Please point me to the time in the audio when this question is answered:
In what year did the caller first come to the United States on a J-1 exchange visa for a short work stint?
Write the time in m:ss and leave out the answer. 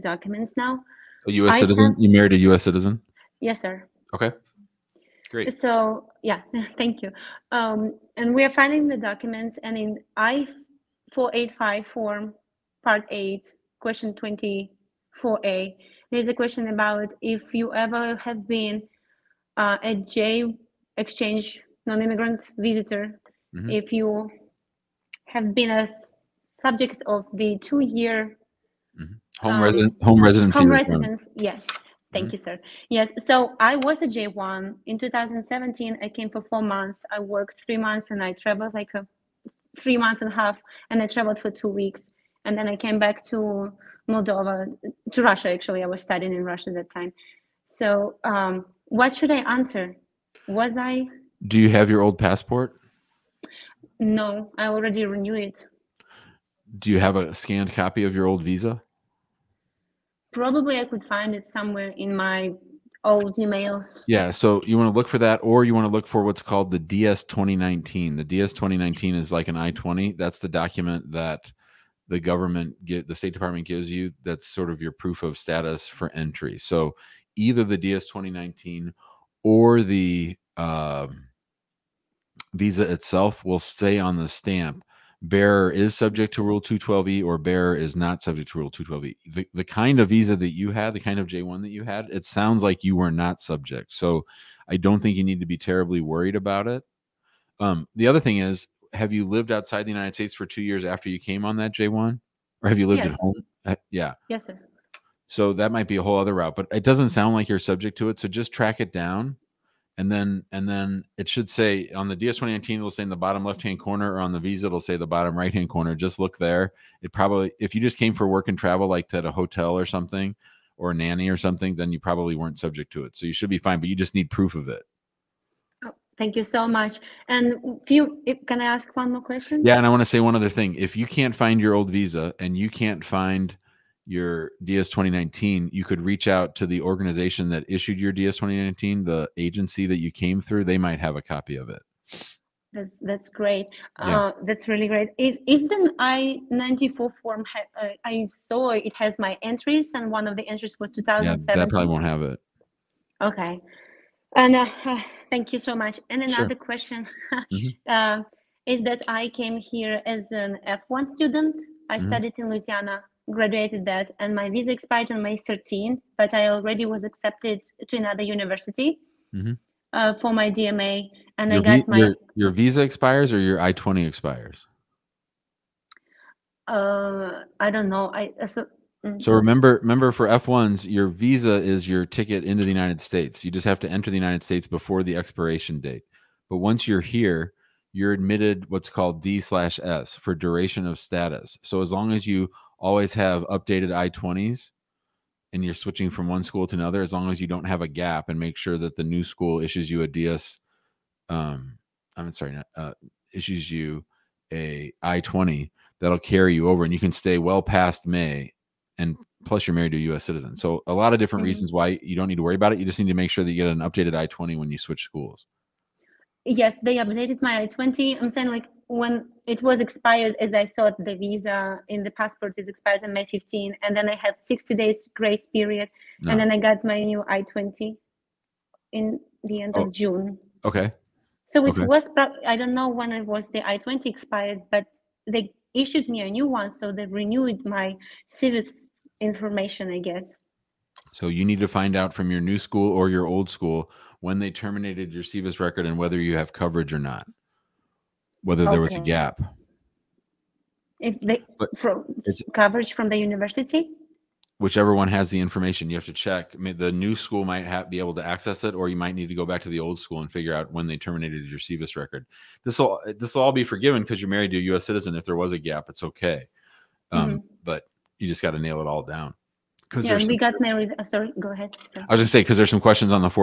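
0:34.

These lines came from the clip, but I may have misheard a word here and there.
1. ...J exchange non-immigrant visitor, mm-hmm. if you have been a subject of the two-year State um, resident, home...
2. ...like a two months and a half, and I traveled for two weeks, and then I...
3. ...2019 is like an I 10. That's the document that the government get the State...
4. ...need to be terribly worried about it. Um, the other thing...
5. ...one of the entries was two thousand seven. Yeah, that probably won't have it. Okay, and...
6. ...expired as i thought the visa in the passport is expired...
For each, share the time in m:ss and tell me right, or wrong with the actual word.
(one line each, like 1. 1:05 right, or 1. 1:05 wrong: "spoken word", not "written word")
1. 0:19 wrong: "Home", not "State"
2. 0:38 wrong: "three", not "two"
3. 1:08 wrong: "20", not "10"
4. 1:35 right
5. 2:30 right
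6. 3:39 right.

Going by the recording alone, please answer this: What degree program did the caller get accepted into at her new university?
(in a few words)
DMA.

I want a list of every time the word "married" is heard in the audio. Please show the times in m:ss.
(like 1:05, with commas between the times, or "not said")
0:02, 3:29, 4:24, 4:30.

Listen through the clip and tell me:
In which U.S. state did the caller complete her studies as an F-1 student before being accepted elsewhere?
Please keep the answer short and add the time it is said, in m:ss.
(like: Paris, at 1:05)
Louisiana, at 2:42.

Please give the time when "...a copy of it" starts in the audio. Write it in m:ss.
2:21.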